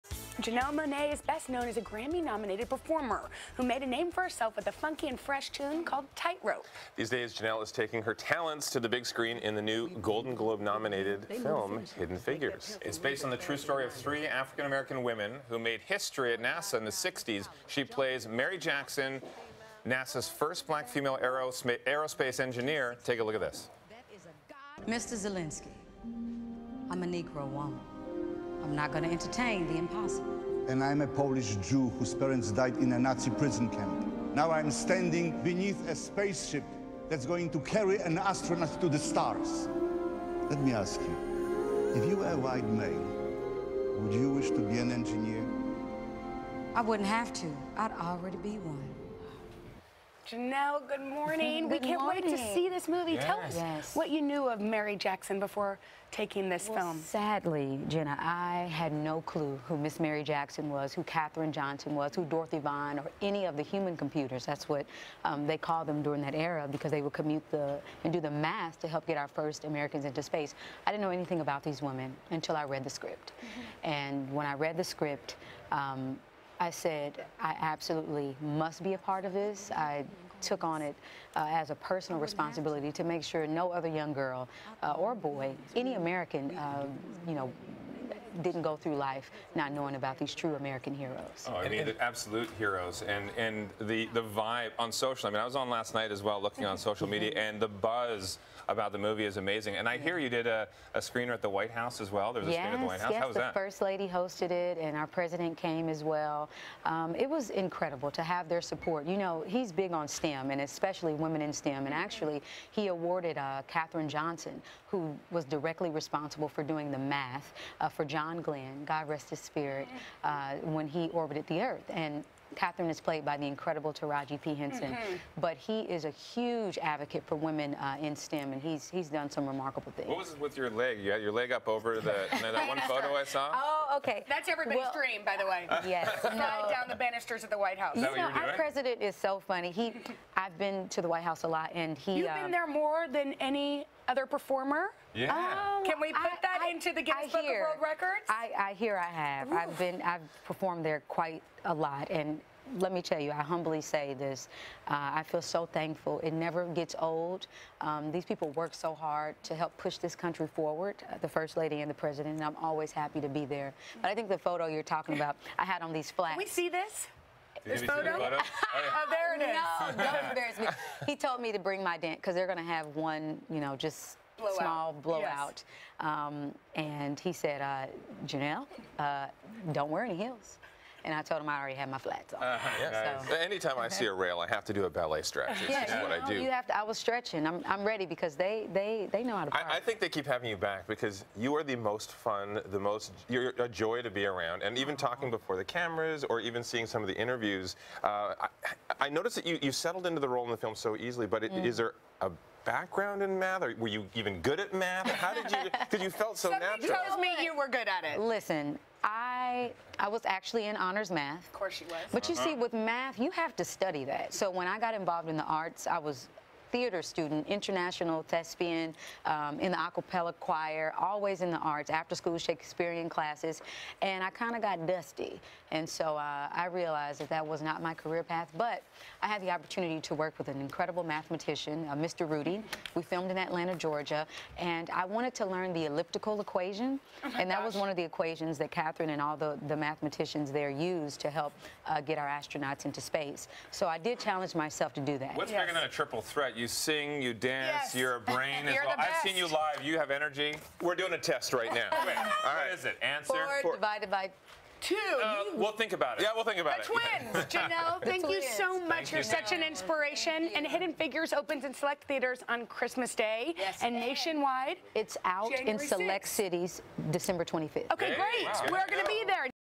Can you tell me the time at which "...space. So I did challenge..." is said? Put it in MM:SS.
04:02.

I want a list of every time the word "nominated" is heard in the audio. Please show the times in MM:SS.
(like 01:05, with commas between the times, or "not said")
00:02, 00:10.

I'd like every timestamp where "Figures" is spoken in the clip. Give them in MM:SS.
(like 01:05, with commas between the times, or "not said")
00:12, 04:20.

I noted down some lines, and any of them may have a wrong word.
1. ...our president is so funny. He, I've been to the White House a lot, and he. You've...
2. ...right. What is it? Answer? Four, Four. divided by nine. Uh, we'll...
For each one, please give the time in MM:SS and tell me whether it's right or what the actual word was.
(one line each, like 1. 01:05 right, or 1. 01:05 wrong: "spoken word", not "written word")
1. 02:18 right
2. 04:12 wrong: "two", not "nine".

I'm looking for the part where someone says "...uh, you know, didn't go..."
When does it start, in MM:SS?
01:26.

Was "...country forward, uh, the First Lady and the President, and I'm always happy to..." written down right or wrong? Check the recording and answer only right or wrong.
right.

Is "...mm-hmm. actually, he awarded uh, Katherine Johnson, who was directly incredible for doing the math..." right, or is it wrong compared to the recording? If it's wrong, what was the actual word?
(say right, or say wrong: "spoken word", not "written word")
wrong: "responsible", not "incredible".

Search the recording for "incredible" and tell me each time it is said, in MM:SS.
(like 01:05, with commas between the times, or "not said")
01:47, 02:03, 03:50.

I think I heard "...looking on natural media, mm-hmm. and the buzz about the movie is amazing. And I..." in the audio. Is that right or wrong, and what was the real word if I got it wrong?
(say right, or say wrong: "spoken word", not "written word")
wrong: "social", not "natural".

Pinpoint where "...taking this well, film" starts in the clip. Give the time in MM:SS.
00:56.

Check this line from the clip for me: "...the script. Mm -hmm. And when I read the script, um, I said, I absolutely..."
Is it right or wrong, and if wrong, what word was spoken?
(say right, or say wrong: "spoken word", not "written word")
right.